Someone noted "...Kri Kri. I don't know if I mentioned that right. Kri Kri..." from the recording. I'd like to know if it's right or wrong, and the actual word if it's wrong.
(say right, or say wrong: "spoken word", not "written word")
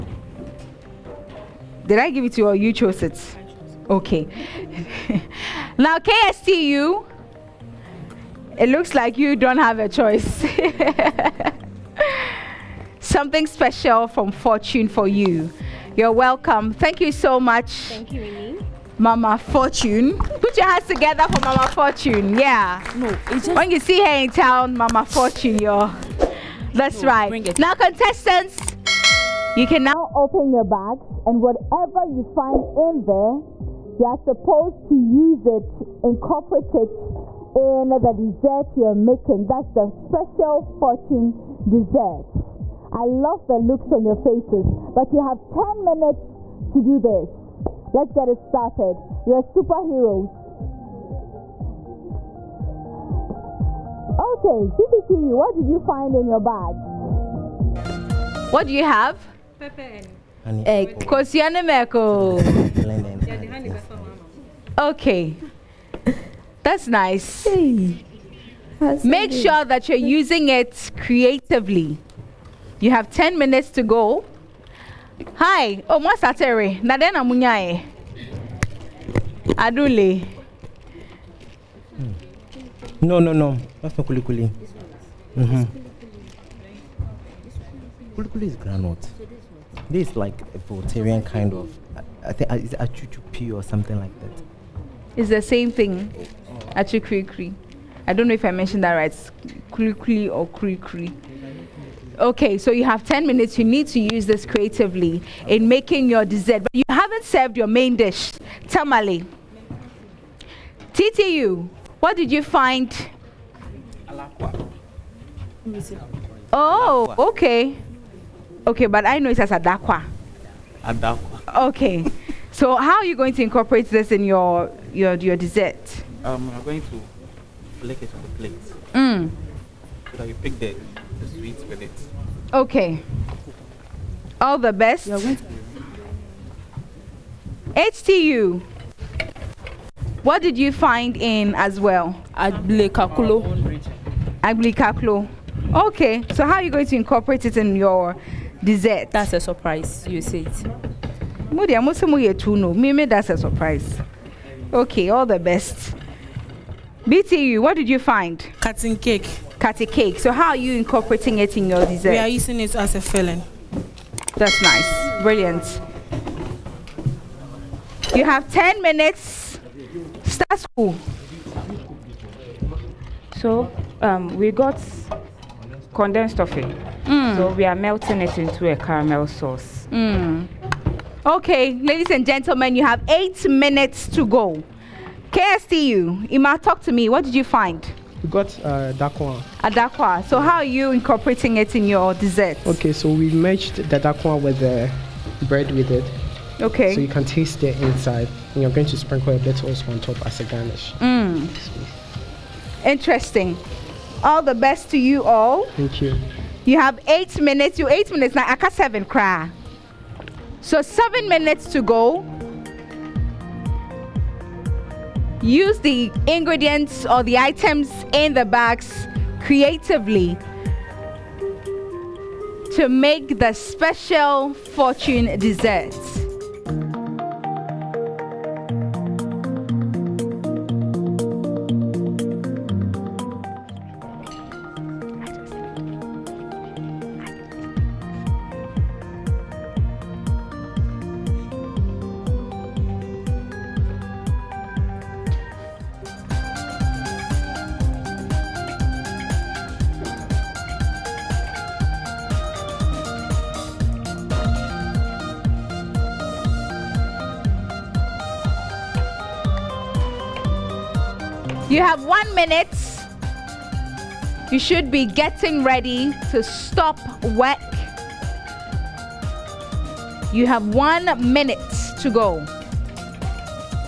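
right.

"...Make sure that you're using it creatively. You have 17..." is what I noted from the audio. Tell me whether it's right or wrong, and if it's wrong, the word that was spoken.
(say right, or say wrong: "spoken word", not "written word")
wrong: "10", not "17".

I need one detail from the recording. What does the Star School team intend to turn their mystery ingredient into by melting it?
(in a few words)
Caramel sauce.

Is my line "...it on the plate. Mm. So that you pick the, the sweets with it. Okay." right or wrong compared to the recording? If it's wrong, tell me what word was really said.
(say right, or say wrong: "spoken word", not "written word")
right.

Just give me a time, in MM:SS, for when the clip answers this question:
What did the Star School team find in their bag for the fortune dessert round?
02:55.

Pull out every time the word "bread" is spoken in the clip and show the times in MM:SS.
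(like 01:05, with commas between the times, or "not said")
03:15.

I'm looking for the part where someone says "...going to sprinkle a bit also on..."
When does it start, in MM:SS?
03:18.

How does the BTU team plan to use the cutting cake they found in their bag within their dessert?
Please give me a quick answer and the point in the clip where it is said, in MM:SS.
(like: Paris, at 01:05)
As a filling, at 02:42.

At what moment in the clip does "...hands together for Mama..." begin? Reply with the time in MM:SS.
00:20.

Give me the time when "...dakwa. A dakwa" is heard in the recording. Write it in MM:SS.
03:08.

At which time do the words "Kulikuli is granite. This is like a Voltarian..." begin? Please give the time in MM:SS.
01:28.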